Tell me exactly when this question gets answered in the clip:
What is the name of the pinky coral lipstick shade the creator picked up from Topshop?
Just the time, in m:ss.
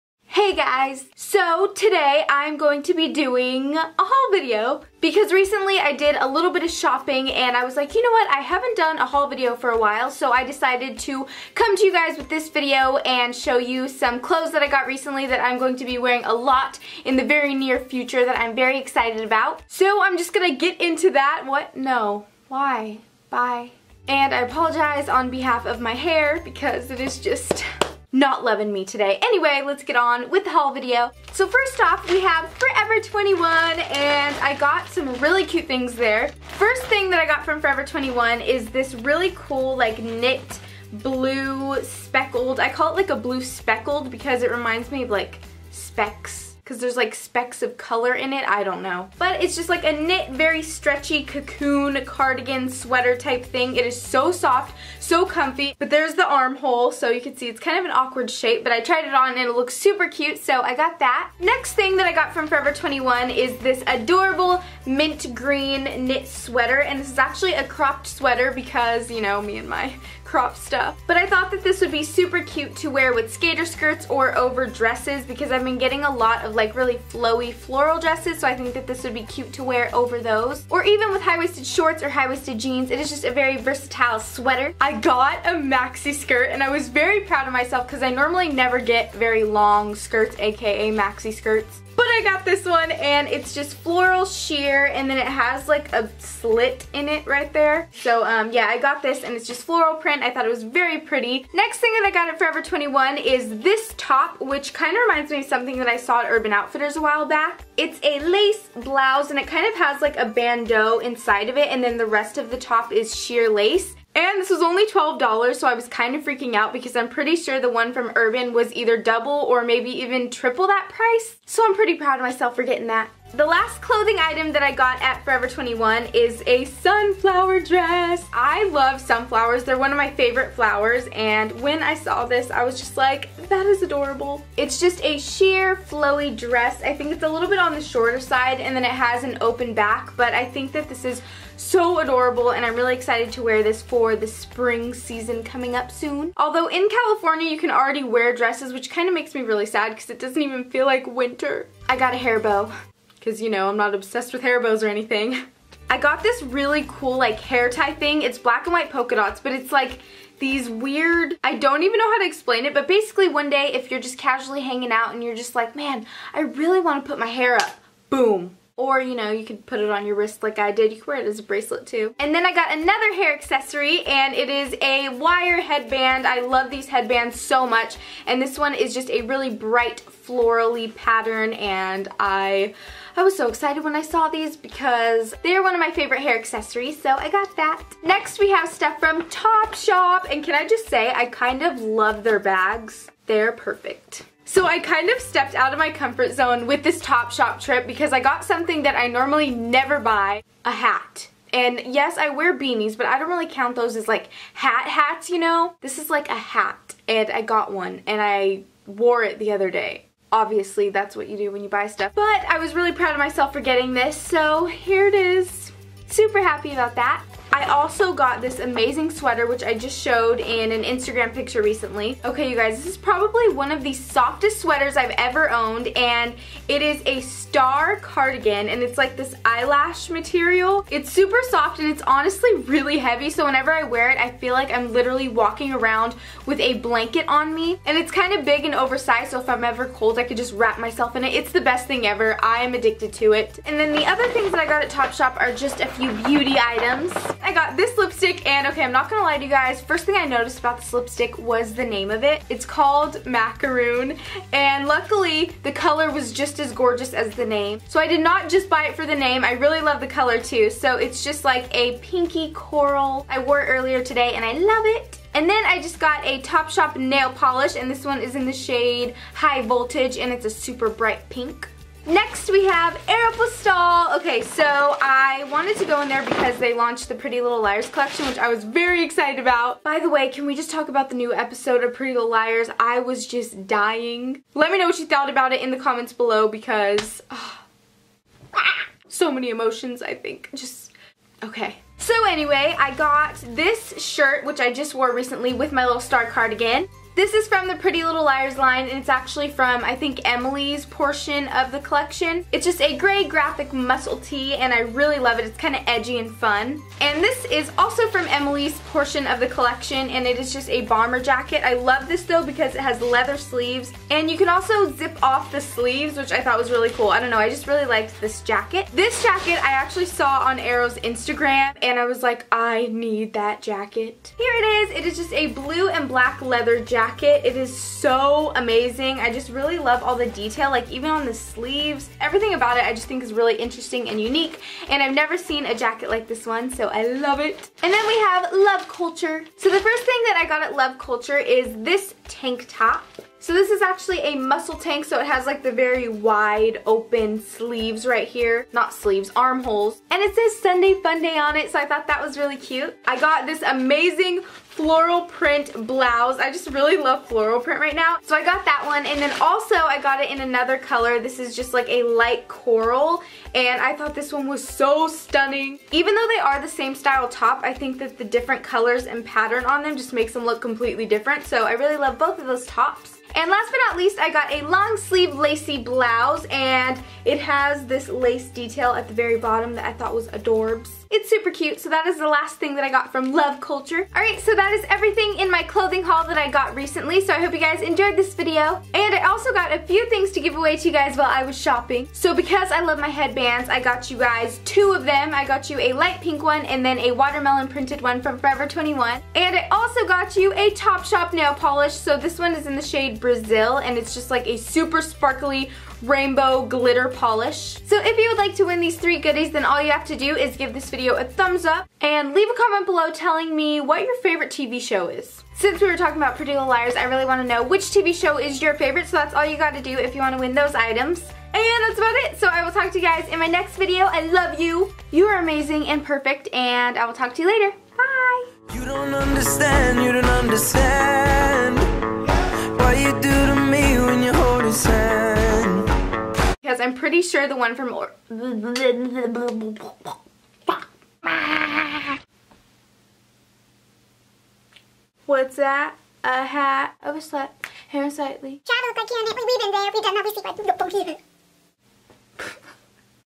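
4:13.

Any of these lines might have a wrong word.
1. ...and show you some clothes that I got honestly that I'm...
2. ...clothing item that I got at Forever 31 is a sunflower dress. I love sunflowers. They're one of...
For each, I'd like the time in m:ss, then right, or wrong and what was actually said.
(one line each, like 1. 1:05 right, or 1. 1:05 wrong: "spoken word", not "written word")
1. 0:12 wrong: "recently", not "honestly"
2. 2:03 wrong: "21", not "31".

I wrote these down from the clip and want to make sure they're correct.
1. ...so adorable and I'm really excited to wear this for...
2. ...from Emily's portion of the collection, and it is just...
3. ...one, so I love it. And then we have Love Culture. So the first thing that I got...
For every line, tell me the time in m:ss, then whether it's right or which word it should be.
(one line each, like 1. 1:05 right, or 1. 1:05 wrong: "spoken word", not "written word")
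1. 2:21 right
2. 5:08 right
3. 5:36 right.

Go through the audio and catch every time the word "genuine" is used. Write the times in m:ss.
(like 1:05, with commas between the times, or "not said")
not said.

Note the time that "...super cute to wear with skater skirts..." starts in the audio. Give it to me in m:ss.
1:12.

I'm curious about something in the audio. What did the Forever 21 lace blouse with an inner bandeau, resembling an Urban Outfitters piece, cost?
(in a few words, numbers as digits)
$12.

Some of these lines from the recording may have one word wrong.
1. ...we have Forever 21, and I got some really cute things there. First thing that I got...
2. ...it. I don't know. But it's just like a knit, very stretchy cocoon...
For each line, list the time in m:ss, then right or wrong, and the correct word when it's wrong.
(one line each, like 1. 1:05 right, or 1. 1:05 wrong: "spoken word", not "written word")
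1. 0:32 right
2. 0:48 right.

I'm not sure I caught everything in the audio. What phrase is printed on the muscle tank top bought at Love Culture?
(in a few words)
Sunday Fun Day.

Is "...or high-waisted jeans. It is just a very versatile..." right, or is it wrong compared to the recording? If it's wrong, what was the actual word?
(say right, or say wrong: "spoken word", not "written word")
right.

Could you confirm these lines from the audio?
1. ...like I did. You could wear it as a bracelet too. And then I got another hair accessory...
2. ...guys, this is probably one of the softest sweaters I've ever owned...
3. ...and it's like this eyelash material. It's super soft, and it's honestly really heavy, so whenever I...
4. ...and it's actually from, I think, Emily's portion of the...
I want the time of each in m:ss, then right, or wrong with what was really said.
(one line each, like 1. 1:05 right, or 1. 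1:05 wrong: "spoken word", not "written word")
1. 2:50 right
2. 3:42 right
3. 3:48 right
4. 4:58 right.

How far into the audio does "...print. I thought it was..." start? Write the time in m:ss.
1:39.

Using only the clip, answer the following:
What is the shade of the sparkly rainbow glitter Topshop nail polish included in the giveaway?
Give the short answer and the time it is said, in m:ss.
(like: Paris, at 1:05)
Brazil, at 6:43.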